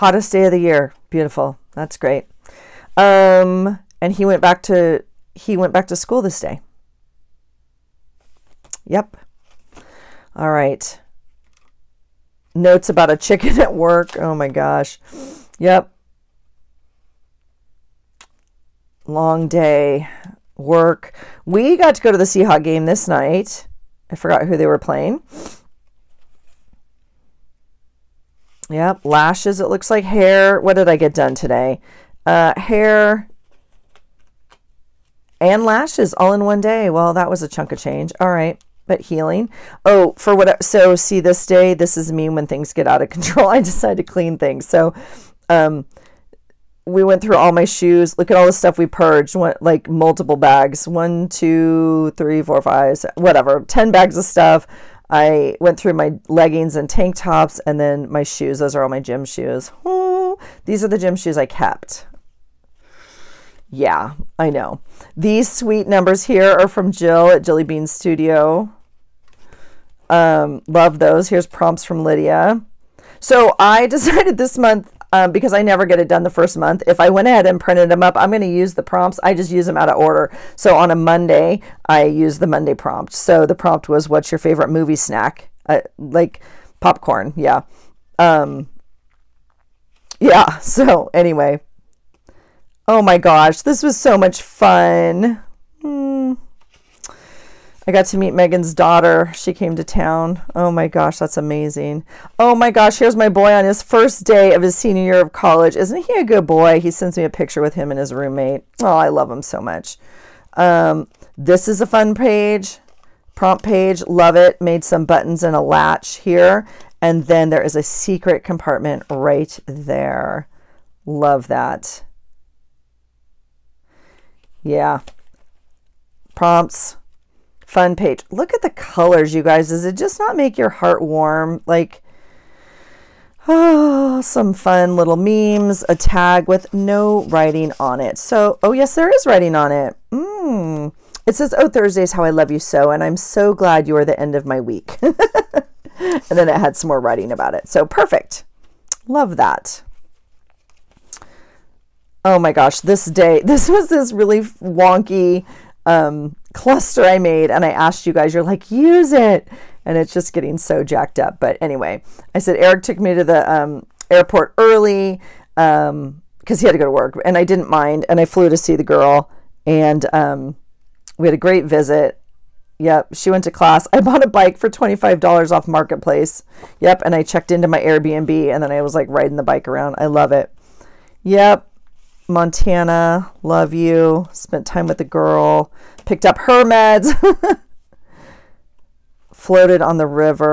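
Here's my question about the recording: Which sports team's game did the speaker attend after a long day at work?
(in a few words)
Seahawks.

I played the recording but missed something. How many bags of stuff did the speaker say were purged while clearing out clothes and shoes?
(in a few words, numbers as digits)
10.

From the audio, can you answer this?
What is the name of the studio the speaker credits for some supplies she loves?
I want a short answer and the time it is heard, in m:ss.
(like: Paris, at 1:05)
Jelly Bean Studio, at 1:07.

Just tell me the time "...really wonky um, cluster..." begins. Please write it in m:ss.
2:34.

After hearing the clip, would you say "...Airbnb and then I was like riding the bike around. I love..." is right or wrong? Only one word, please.
right.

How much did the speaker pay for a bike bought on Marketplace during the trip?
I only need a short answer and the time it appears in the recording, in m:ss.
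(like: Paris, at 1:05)
$25, at 2:54.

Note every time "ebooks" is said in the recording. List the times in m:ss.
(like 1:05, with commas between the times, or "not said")
not said.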